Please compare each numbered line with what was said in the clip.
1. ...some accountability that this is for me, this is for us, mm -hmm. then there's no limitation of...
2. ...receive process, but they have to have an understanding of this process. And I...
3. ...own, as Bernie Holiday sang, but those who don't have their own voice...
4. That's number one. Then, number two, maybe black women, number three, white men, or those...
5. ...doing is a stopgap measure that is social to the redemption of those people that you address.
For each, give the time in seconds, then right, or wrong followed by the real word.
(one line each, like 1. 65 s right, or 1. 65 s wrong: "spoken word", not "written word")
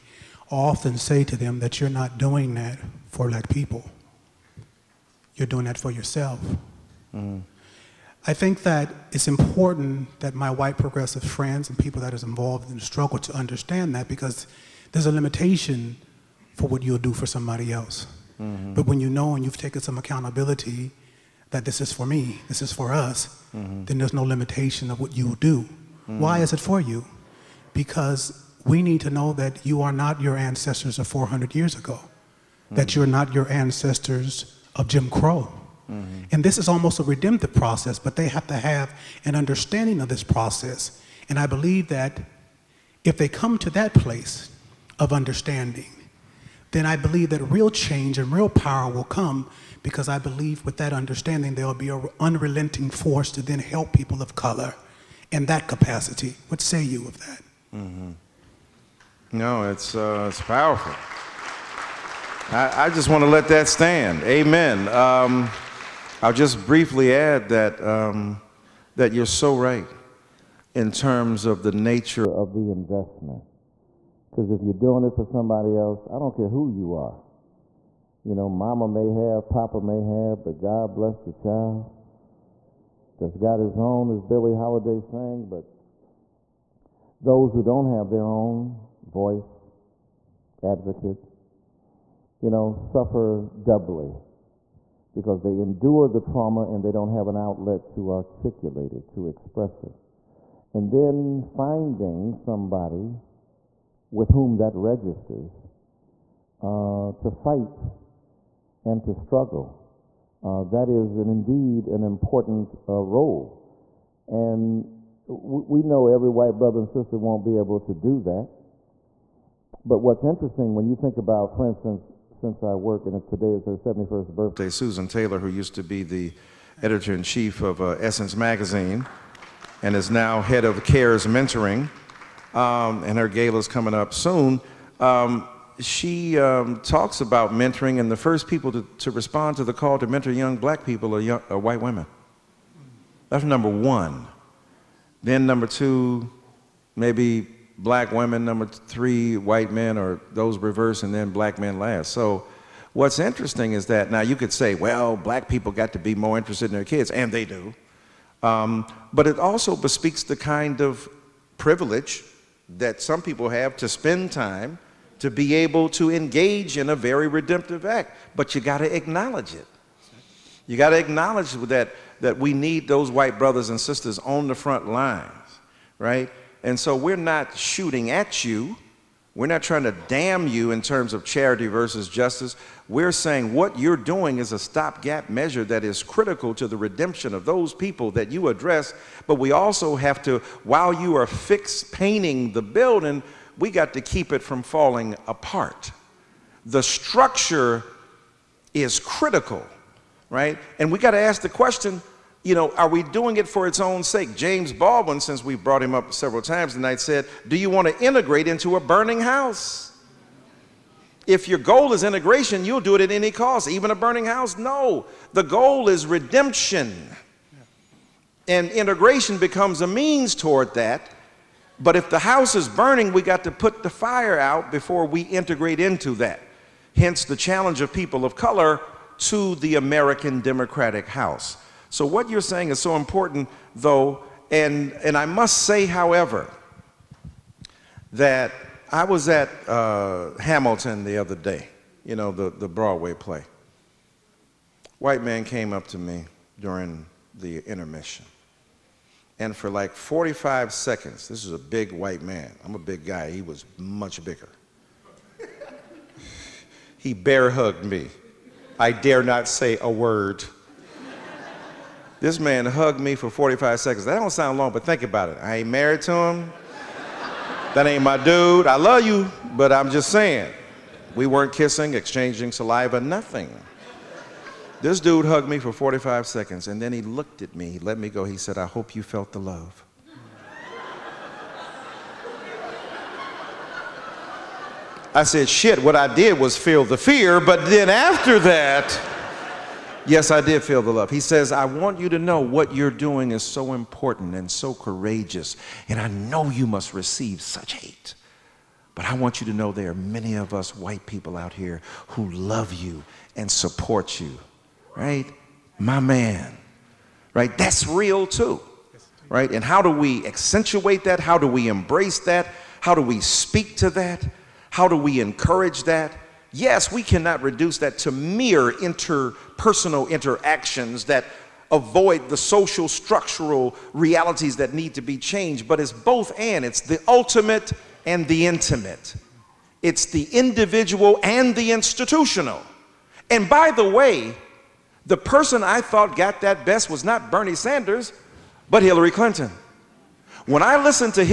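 1. 19 s right
2. 37 s wrong: "redemptive", not "receive"
3. 83 s wrong: "Billie", not "Bernie"
4. 143 s right
5. 183 s wrong: "critical", not "social".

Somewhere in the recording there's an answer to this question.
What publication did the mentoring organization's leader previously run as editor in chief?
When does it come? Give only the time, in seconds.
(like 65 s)
127 s.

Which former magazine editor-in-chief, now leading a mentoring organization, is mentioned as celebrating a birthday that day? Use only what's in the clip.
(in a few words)
Susan Taylor.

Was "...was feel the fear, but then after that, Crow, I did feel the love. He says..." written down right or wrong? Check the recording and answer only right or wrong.
wrong.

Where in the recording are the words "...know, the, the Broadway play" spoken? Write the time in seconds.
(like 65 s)
242 s.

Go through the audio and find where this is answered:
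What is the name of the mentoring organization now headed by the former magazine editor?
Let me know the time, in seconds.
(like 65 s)
130 s.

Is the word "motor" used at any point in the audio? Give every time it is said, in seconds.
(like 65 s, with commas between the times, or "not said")
not said.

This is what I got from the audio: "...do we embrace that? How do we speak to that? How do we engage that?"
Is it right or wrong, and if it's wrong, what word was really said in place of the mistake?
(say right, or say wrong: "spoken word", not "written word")
wrong: "encourage", not "engage".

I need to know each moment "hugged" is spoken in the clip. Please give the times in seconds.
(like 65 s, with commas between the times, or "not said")
257 s, 262 s, 275 s.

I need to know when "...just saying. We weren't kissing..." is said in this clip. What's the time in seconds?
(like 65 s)
269 s.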